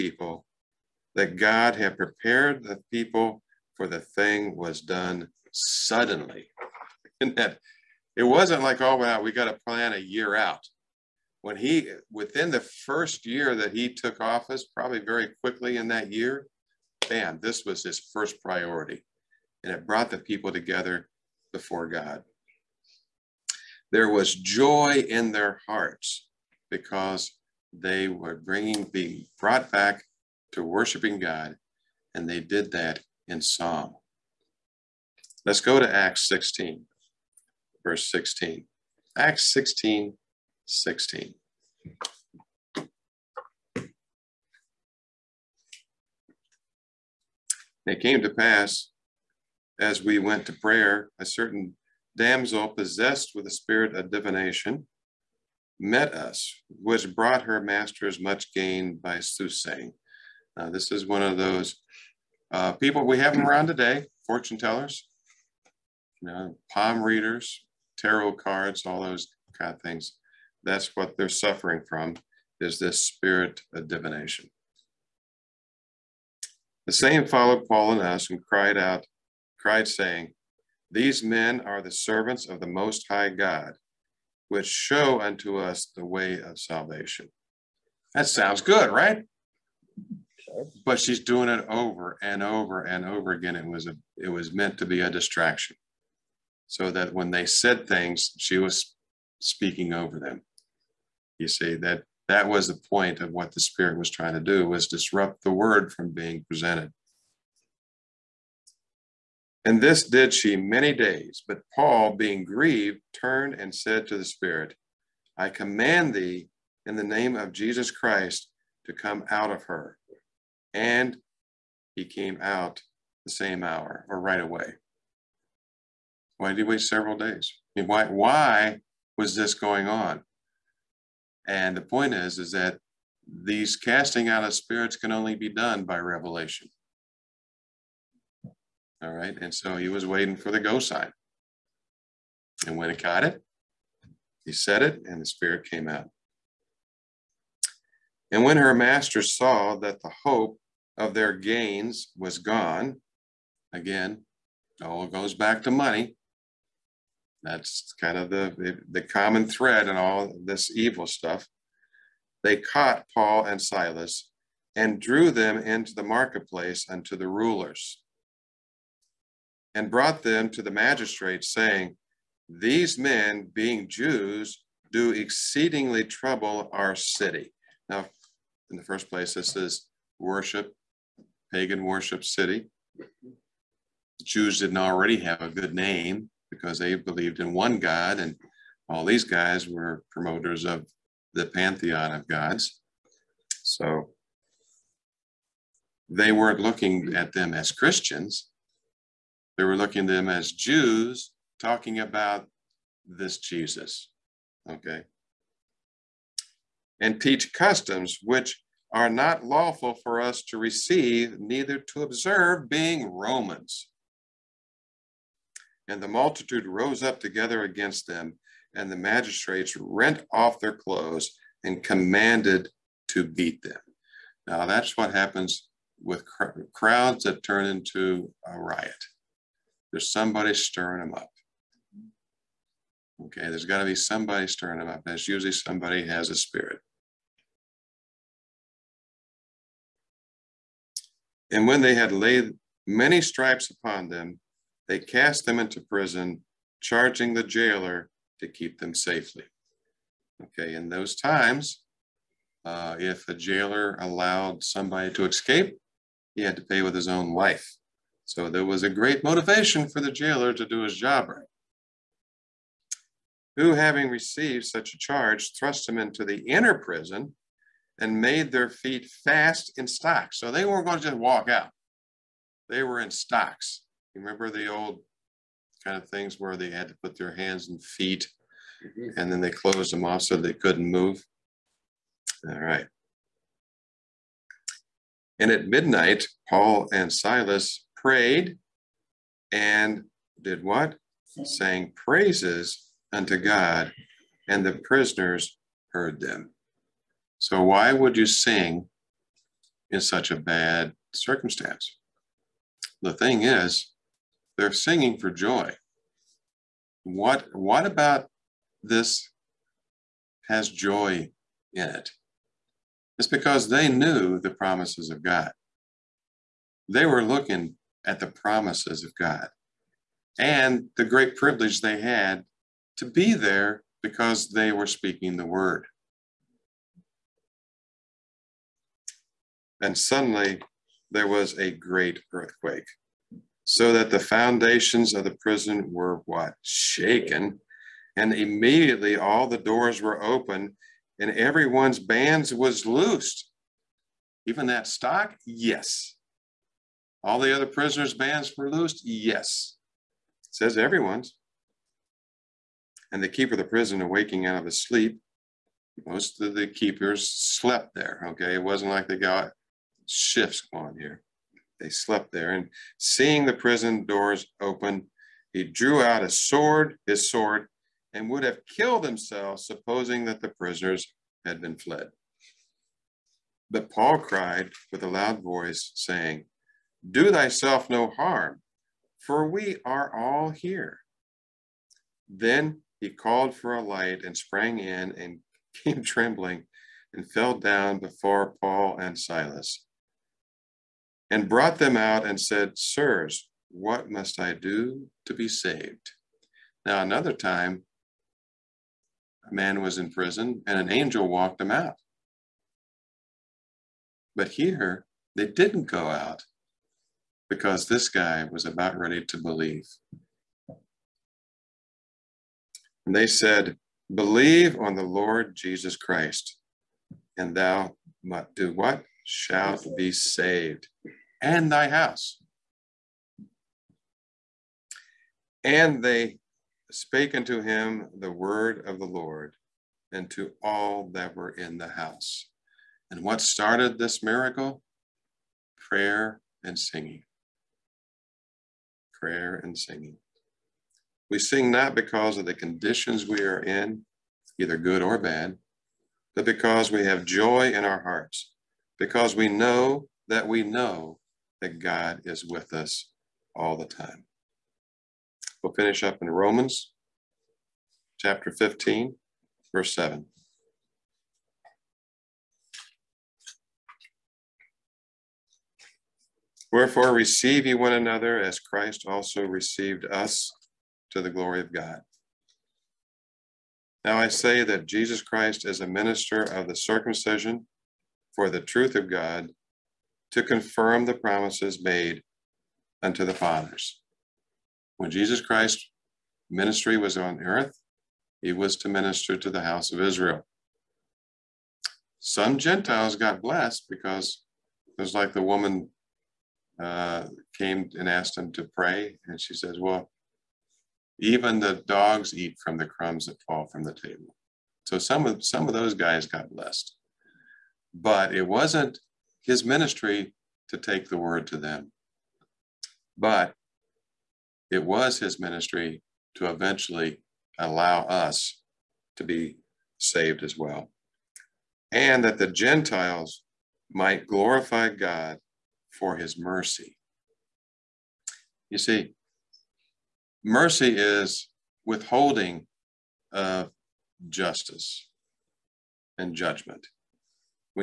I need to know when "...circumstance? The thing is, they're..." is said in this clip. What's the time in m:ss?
5:01.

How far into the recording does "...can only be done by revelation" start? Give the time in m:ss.
2:14.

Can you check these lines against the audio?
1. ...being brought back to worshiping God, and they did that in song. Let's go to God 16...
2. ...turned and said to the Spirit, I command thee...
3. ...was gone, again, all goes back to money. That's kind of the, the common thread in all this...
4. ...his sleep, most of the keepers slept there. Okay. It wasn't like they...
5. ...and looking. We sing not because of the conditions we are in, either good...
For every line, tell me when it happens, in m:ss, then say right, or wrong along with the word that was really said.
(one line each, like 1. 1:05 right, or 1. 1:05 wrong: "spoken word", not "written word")
1. 0:28 wrong: "Acts", not "God"
2. 1:53 right
3. 2:32 right
4. 5:54 right
5. 7:19 wrong: "singing", not "looking".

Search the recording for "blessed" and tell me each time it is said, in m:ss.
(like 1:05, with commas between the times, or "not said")
8:13, 8:26.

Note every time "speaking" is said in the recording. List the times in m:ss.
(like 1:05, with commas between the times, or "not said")
1:39, 5:24.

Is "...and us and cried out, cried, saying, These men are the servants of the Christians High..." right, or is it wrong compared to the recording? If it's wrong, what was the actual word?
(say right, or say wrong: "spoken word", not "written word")
wrong: "Most", not "Christians".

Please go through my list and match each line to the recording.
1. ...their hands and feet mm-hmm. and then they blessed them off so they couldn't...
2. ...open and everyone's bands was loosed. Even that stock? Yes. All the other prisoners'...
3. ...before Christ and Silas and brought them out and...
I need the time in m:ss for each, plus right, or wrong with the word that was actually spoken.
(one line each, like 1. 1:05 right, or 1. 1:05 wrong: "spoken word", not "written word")
1. 4:37 wrong: "closed", not "blessed"
2. 5:40 right
3. 6:27 wrong: "Paul", not "Christ".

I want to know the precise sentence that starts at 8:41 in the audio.
And that the Gentiles might glorify God for his mercy.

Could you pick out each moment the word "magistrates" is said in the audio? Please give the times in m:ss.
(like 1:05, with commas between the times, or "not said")
2:50, 3:38.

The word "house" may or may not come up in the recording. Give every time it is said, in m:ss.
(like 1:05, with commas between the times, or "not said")
7:01, 7:11, 8:09.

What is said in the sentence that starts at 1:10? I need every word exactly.
That's what they're suffering from is this spirit of divination.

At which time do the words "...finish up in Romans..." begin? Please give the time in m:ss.
7:35.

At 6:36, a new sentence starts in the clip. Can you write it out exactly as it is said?
Now, another time, a man was in prison and an angel walked him out.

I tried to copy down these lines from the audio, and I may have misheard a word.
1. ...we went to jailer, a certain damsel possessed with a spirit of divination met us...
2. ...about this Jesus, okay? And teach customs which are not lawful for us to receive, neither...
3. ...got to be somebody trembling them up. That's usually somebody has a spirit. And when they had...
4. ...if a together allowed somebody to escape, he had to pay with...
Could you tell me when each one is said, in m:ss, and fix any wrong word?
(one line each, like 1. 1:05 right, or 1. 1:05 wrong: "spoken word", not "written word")
1. 0:50 wrong: "prayer", not "jailer"
2. 3:22 right
3. 3:53 wrong: "stirring", not "trembling"
4. 4:12 wrong: "jailer", not "together".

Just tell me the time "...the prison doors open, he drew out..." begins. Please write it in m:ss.
6:03.